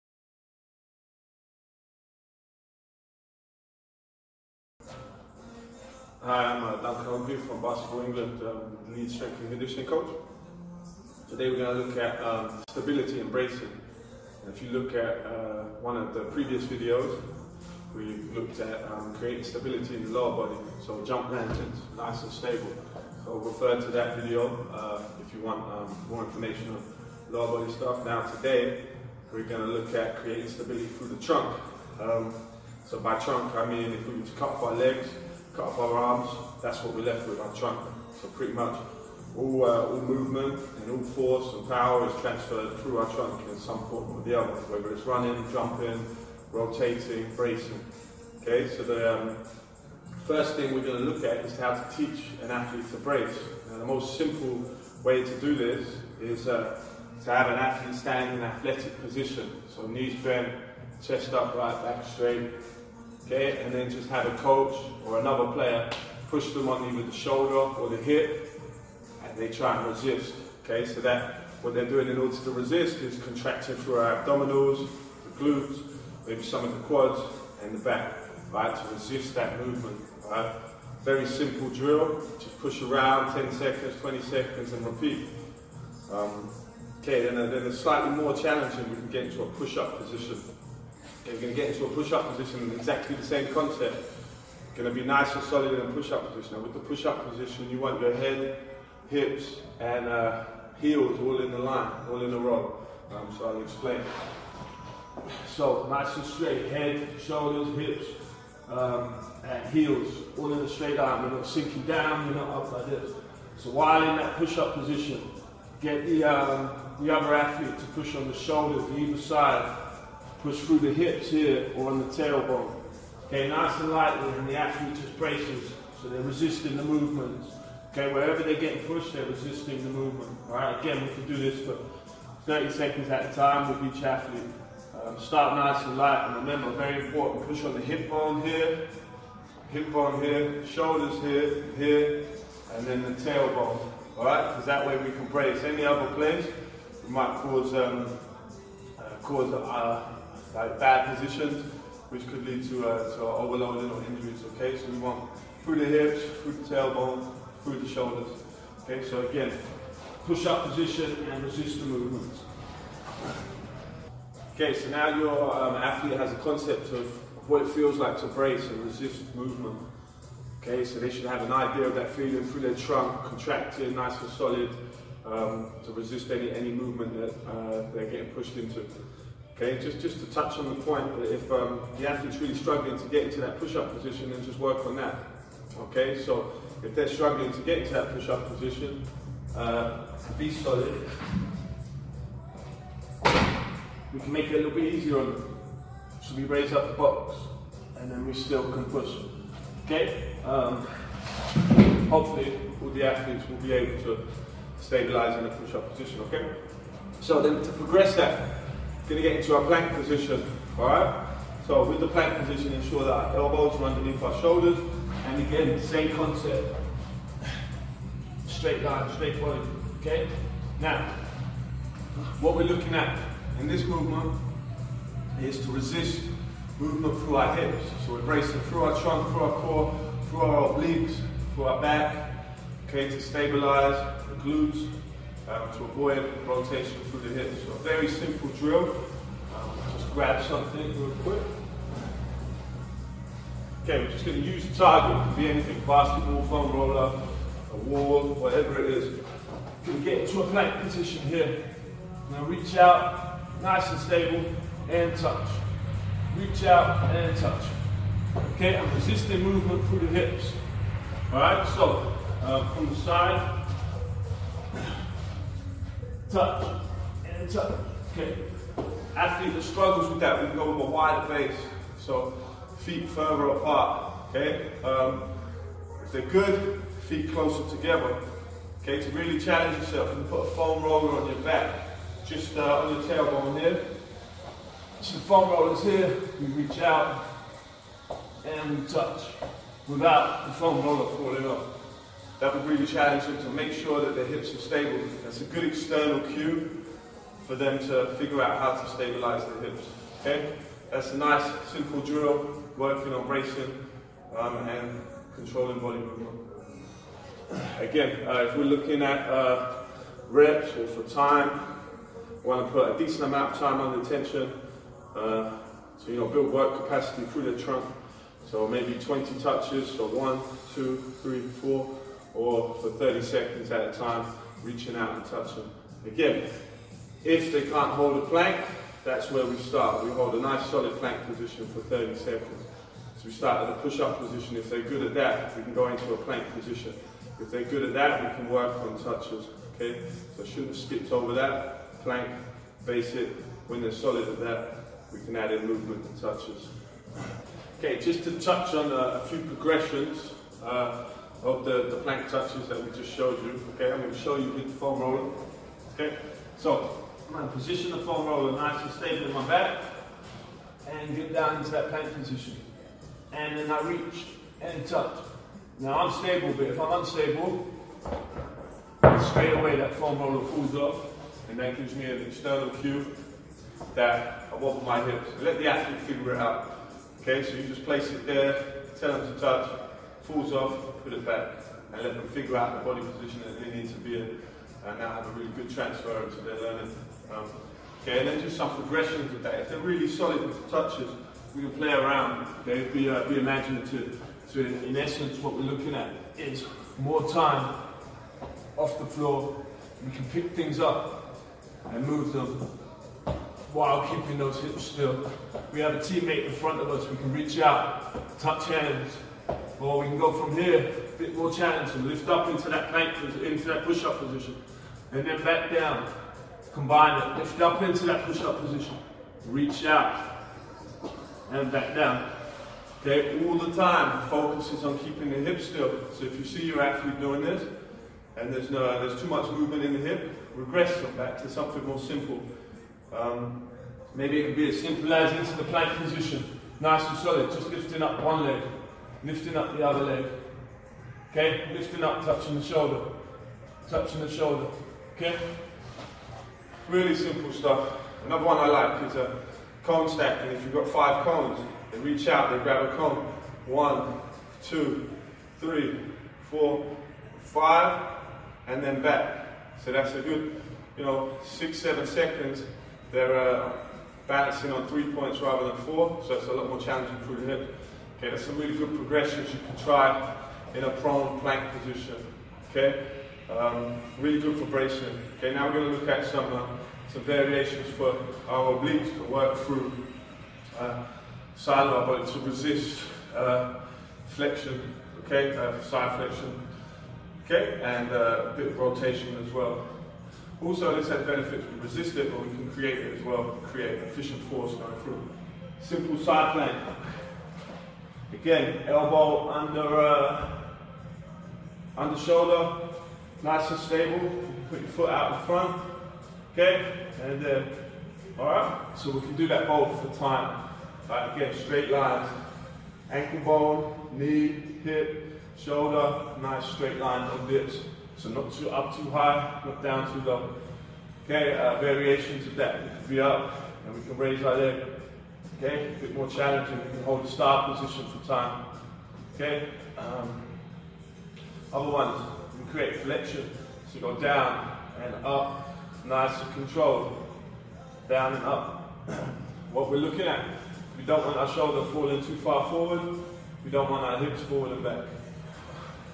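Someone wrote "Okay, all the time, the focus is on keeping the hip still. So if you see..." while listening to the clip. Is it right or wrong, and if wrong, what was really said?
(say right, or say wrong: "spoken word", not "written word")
right.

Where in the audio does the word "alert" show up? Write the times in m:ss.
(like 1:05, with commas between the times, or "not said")
not said.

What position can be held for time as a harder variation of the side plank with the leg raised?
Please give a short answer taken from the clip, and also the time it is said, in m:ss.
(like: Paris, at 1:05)
star position, at 8:47.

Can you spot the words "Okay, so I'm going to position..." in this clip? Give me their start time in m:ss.
5:55.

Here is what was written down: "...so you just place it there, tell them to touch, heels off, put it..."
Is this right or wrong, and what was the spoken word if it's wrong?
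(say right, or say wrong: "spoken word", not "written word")
wrong: "falls", not "heels".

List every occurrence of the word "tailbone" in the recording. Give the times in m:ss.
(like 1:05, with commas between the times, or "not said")
2:02, 2:23, 2:36, 4:43.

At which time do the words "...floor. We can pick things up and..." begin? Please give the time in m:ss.
6:39.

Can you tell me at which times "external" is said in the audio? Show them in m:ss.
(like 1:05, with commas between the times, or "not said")
4:55, 6:12.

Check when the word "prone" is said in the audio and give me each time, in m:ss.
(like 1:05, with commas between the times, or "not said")
7:50.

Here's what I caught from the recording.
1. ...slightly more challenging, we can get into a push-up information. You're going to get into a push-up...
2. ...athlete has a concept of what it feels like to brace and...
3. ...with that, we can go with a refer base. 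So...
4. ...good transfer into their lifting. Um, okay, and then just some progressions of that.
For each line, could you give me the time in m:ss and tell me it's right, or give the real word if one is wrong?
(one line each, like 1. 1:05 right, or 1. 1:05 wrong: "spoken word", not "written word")
1. 1:27 wrong: "position", not "information"
2. 2:45 right
3. 4:30 wrong: "wider", not "refer"
4. 6:25 wrong: "learning", not "lifting".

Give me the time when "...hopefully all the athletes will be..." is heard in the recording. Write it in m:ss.
3:22.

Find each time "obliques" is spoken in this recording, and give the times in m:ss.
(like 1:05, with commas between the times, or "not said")
3:50, 7:58.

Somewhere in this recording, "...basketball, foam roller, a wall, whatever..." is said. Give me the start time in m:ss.
4:05.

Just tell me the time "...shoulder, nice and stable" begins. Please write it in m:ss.
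8:22.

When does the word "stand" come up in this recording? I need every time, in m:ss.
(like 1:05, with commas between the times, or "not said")
0:57.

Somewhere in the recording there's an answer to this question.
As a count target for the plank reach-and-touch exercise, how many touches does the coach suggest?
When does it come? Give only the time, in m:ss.
5:18.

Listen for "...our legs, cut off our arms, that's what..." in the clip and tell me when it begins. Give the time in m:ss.
0:34.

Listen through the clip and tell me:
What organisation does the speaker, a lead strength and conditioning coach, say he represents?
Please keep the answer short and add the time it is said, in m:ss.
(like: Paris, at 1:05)
Basketball England, at 0:07.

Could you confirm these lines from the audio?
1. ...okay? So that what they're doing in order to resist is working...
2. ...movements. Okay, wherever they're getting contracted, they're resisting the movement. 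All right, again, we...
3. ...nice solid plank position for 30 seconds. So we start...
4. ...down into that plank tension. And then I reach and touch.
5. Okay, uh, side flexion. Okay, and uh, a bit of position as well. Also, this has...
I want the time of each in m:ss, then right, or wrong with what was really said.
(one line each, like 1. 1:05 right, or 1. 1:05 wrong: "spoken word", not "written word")
1. 1:10 wrong: "contracting", not "working"
2. 2:06 wrong: "pushed", not "contracted"
3. 5:30 right
4. 6:01 wrong: "position", not "tension"
5. 8:05 wrong: "rotation", not "position".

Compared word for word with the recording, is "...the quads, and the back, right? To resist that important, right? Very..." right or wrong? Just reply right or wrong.
wrong.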